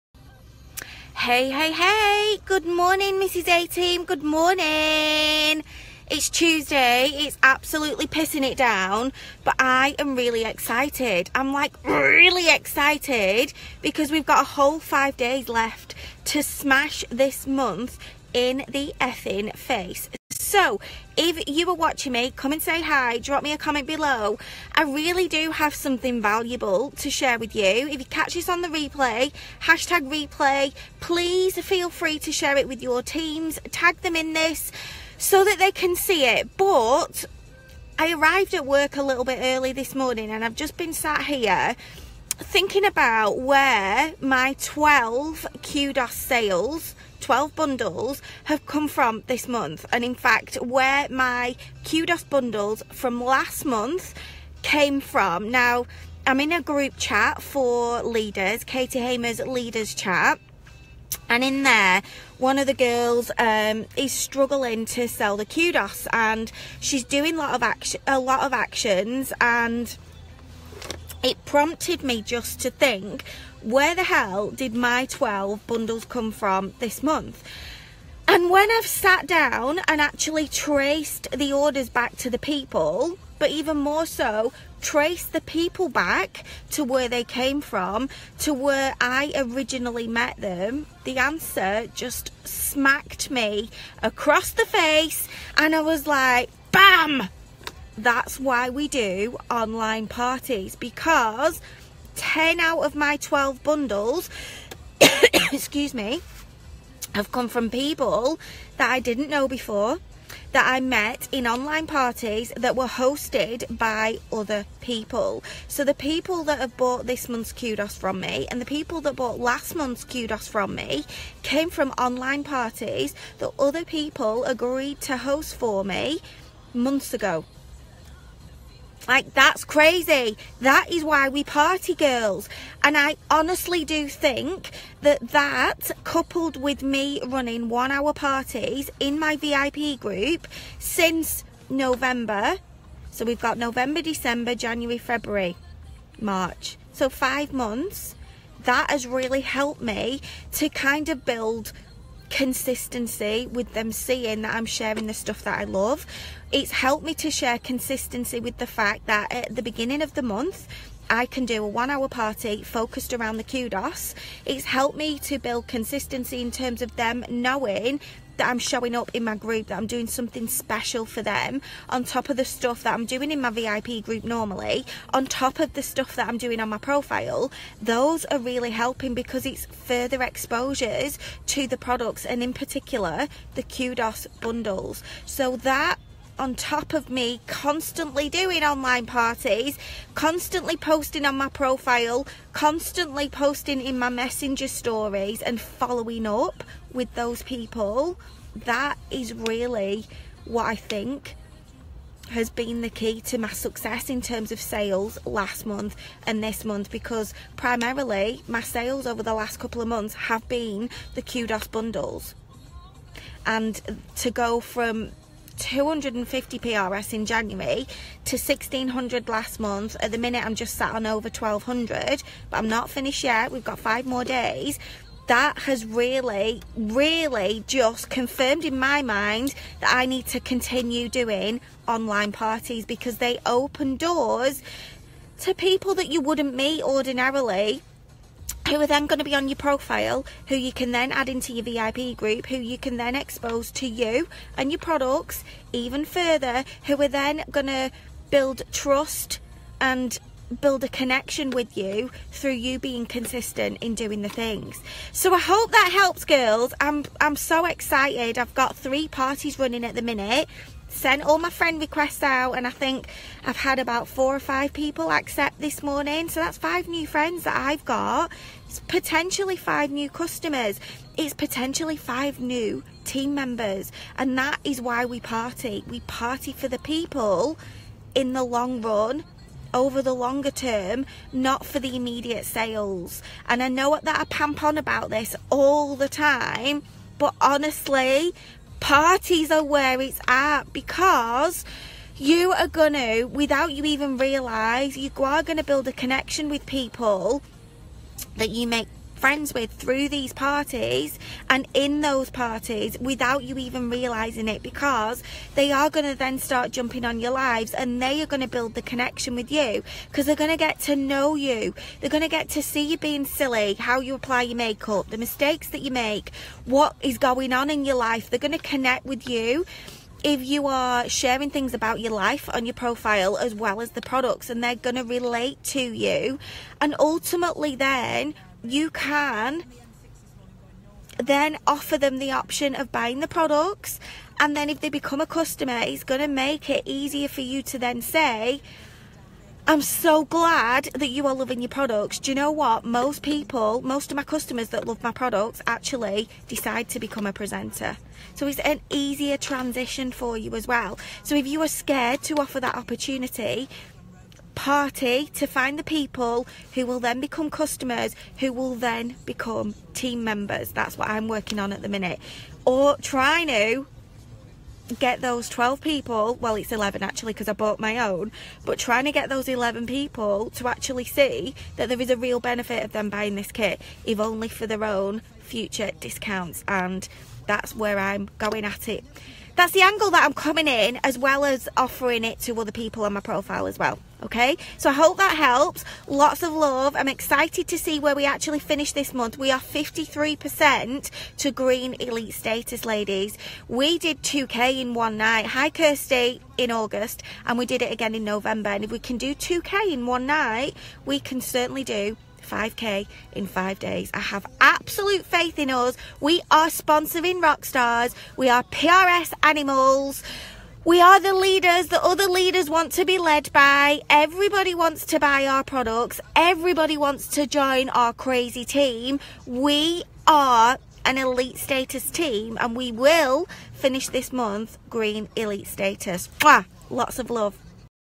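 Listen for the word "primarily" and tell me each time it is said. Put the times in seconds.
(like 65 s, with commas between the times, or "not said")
207 s.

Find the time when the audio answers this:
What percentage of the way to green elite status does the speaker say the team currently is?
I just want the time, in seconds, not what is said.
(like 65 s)
389 s.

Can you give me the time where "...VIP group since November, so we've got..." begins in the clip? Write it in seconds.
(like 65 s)
139 s.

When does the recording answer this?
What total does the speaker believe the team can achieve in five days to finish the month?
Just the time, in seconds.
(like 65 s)
402 s.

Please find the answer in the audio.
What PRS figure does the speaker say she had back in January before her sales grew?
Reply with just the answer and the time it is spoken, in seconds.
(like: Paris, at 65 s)
250, at 215 s.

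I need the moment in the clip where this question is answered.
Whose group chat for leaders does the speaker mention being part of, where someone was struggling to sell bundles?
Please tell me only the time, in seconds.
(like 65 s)
58 s.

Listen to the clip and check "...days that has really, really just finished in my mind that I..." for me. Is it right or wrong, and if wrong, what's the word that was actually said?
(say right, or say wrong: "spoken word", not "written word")
wrong: "confirmed", not "finished".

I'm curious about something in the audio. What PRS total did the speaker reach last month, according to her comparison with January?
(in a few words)
1600.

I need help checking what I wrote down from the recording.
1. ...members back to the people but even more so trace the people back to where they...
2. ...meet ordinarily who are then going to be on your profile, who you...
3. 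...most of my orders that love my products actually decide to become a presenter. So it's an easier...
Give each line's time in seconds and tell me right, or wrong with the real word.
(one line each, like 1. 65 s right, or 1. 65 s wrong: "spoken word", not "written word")
1. 81 s wrong: "orders", not "members"
2. 236 s right
3. 343 s wrong: "customers", not "orders".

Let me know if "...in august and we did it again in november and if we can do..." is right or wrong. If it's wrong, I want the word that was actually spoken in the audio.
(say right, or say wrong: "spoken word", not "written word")
right.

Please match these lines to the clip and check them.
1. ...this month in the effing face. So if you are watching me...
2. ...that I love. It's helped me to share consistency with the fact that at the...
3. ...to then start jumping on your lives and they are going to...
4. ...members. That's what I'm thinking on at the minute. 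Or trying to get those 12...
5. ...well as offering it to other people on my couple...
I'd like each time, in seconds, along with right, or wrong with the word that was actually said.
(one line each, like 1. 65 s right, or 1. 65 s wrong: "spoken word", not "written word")
1. 17 s right
2. 155 s right
3. 306 s right
4. 360 s wrong: "working", not "thinking"
5. 381 s wrong: "profile", not "couple".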